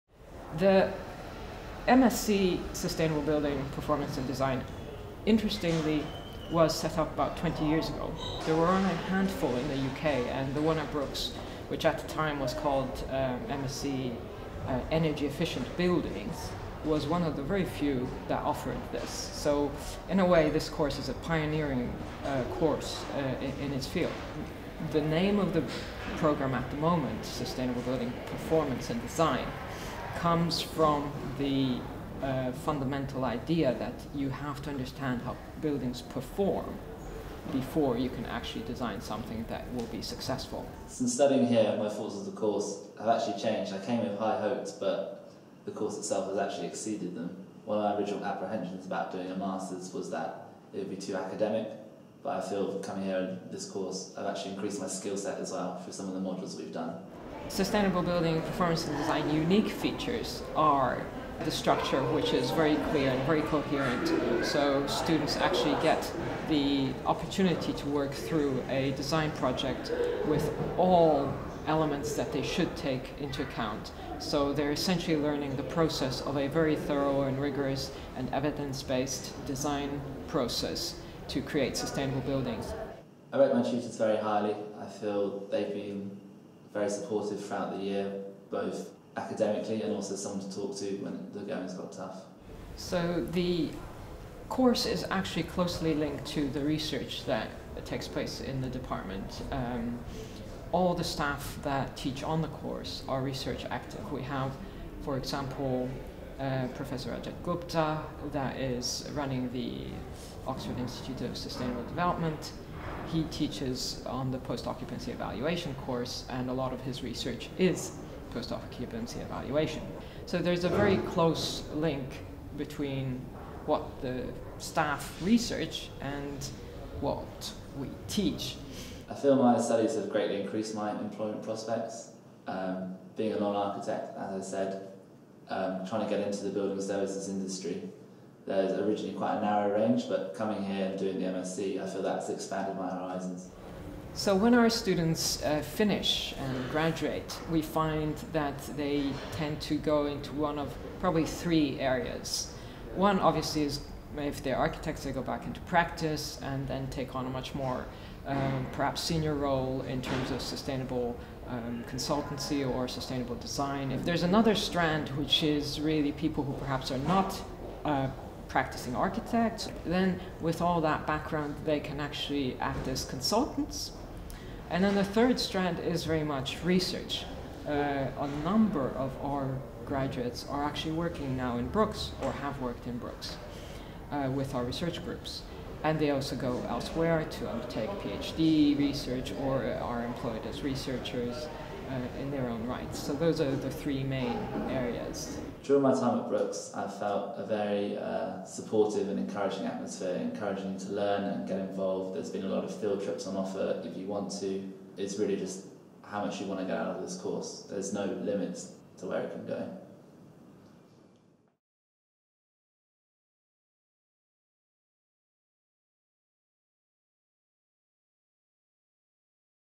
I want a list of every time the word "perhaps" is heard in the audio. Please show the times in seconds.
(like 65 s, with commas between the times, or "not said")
158 s, 166 s.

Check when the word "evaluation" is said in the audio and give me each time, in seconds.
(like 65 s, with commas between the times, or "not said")
115 s, 119 s.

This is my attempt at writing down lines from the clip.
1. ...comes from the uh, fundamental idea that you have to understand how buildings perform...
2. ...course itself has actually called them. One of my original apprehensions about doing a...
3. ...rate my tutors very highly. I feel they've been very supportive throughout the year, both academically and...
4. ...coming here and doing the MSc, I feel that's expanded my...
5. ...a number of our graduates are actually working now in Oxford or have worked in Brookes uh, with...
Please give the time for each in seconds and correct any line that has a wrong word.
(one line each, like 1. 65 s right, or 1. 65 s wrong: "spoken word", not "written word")
1. 30 s right
2. 45 s wrong: "exceeded", not "called"
3. 83 s right
4. 140 s right
5. 177 s wrong: "Brookes", not "Oxford".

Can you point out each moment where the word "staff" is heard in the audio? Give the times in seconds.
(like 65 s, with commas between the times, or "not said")
101 s, 124 s.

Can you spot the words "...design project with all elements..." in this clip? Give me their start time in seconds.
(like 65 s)
68 s.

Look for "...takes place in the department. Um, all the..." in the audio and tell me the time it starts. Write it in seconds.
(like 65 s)
97 s.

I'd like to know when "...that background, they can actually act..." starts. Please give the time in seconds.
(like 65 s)
170 s.